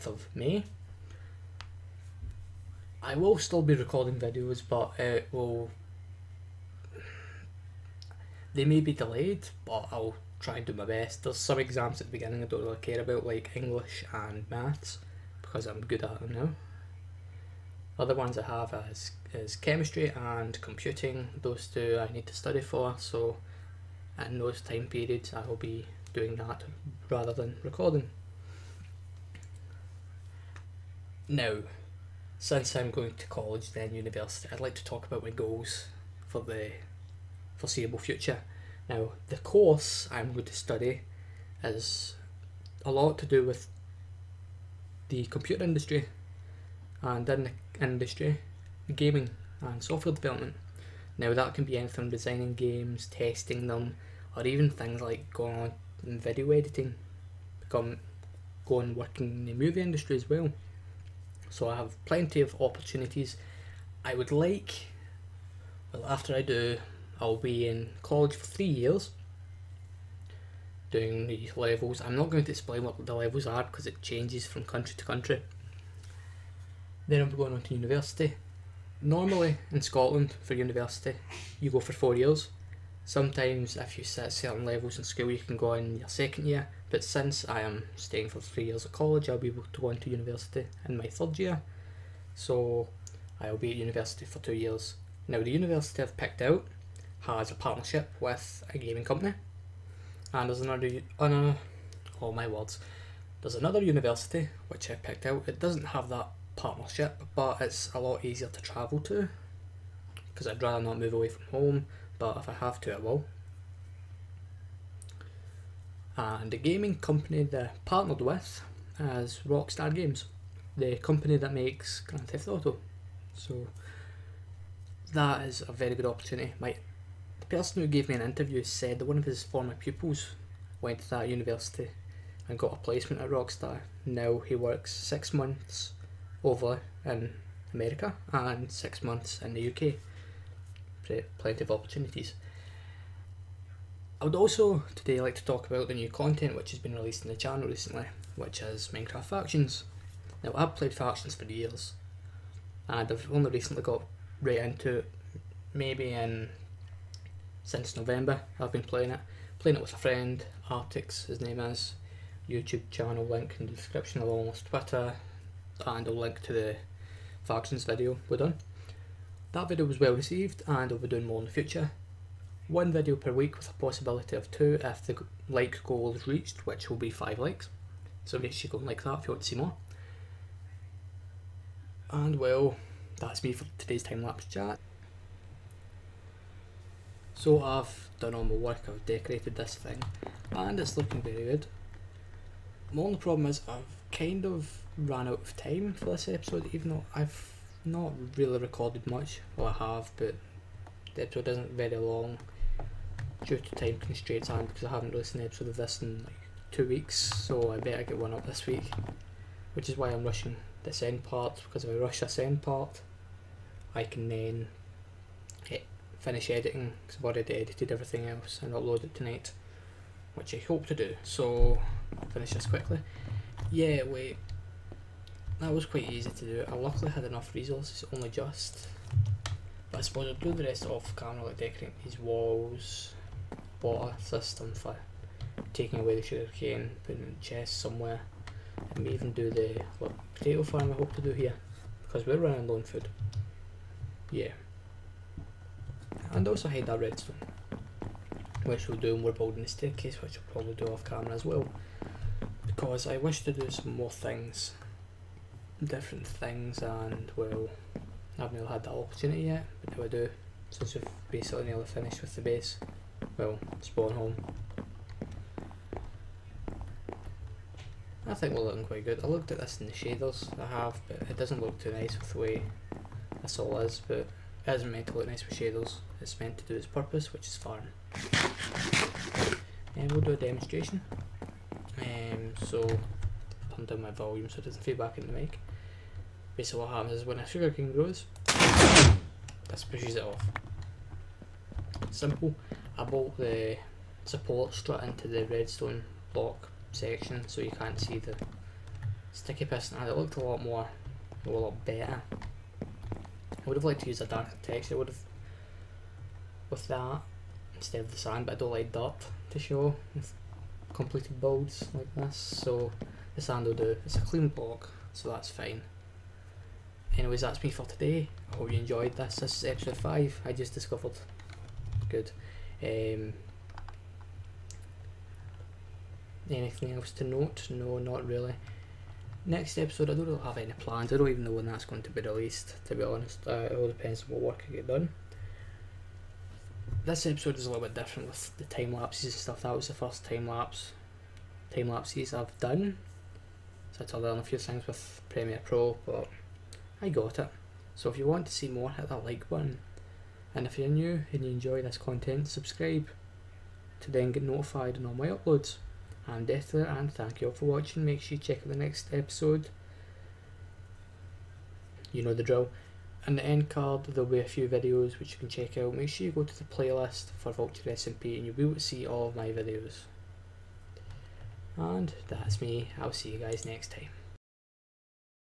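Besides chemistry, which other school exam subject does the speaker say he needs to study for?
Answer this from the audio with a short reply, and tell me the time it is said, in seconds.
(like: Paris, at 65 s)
Computing, at 20 s.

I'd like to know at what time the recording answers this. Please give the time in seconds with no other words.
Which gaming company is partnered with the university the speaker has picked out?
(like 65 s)
119 s.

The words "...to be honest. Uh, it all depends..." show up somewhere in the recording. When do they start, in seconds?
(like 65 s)
332 s.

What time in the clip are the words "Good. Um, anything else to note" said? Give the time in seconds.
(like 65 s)
322 s.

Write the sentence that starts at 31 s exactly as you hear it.
Now, since I'm going to college, then university, I'd like to talk about my goals for the foreseeable future.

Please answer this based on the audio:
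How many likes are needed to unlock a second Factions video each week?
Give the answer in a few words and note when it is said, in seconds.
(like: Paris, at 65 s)
5, at 177 s.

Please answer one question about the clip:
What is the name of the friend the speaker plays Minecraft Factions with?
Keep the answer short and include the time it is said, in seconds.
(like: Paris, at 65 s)
Artiicz, at 160 s.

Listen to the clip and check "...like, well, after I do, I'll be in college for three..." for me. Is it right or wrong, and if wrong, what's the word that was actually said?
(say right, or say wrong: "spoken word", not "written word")
right.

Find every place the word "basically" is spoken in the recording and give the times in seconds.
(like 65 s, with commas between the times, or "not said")
261 s, 286 s.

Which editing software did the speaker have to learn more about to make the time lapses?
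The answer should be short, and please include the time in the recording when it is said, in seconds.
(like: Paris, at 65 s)
Premiere Pro, at 345 s.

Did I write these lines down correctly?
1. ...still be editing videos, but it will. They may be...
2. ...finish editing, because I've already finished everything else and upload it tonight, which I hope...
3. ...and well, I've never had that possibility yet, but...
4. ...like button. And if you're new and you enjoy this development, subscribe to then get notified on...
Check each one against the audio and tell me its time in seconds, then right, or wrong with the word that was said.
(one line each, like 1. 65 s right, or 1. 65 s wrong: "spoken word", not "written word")
1. 3 s wrong: "recording", not "editing"
2. 216 s wrong: "edited", not "finished"
3. 256 s wrong: "opportunity", not "possibility"
4. 349 s wrong: "content", not "development".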